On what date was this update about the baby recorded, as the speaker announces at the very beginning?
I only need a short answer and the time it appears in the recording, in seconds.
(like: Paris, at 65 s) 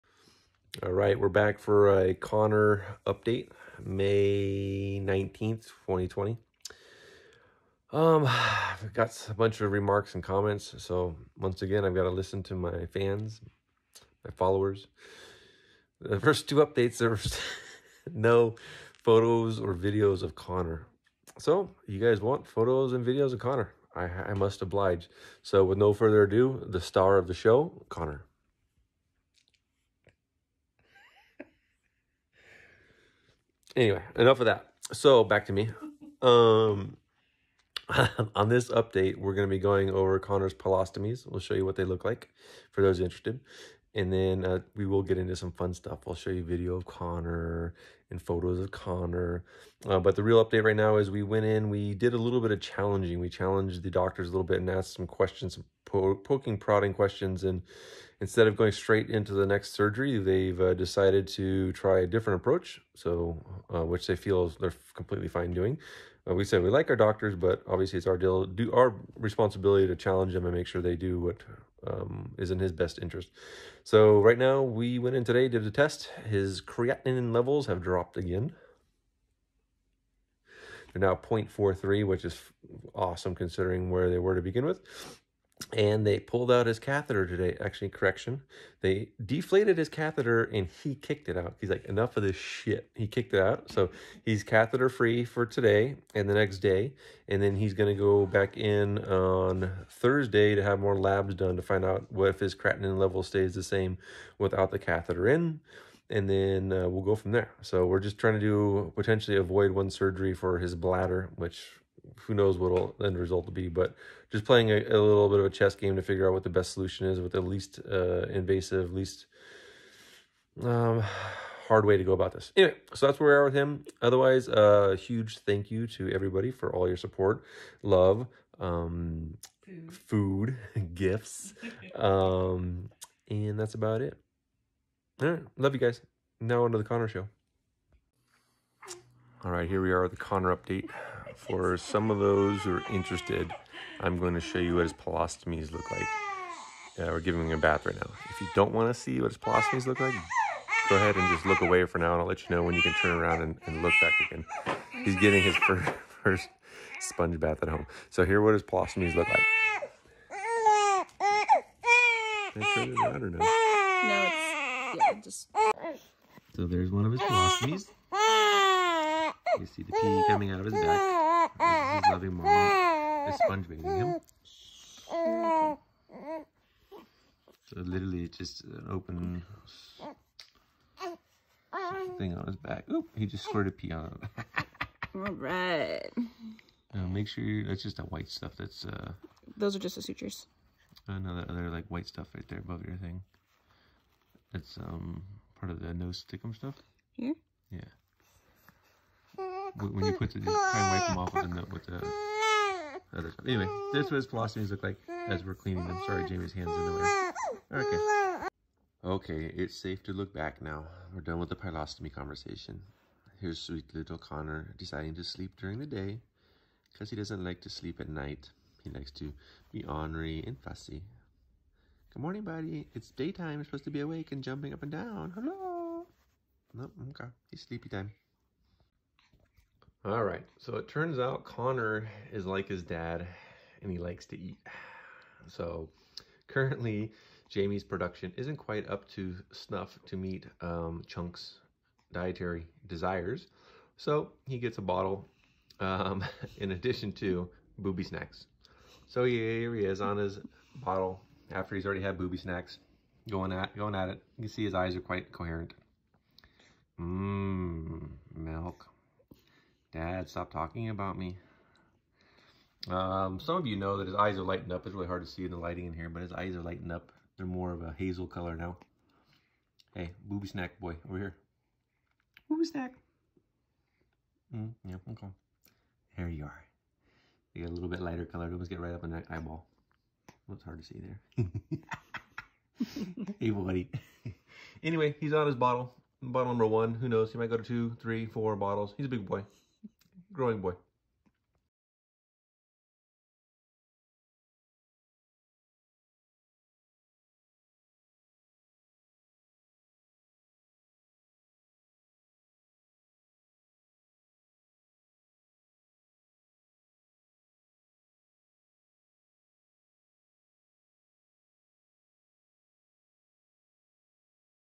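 May 19th, 2020, at 3 s.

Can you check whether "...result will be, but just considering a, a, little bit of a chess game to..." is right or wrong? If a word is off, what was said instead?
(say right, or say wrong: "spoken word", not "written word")
wrong: "playing", not "considering".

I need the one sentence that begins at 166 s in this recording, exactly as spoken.
So there's one of his pyelostomies.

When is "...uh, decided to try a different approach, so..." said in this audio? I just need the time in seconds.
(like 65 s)
60 s.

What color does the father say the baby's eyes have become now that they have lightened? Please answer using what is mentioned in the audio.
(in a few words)
hazel.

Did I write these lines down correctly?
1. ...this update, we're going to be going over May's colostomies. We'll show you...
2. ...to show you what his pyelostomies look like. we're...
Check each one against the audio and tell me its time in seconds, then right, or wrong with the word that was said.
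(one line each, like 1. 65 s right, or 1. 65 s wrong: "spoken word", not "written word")
1. 38 s wrong: "Connor", not "May"
2. 144 s right.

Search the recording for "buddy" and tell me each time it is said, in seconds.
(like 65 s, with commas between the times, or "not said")
222 s, 283 s.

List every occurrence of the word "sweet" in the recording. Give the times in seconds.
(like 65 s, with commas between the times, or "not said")
213 s.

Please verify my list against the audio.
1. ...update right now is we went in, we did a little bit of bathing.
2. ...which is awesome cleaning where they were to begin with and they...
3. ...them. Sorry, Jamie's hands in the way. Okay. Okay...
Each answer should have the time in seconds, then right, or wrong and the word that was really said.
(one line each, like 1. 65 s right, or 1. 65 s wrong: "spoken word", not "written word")
1. 50 s wrong: "challenging", not "bathing"
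2. 82 s wrong: "considering", not "cleaning"
3. 205 s right.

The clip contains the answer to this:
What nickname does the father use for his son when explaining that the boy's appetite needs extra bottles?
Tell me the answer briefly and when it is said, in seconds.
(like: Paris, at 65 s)
Chunk, at 241 s.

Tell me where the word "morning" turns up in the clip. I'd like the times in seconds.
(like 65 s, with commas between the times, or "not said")
222 s.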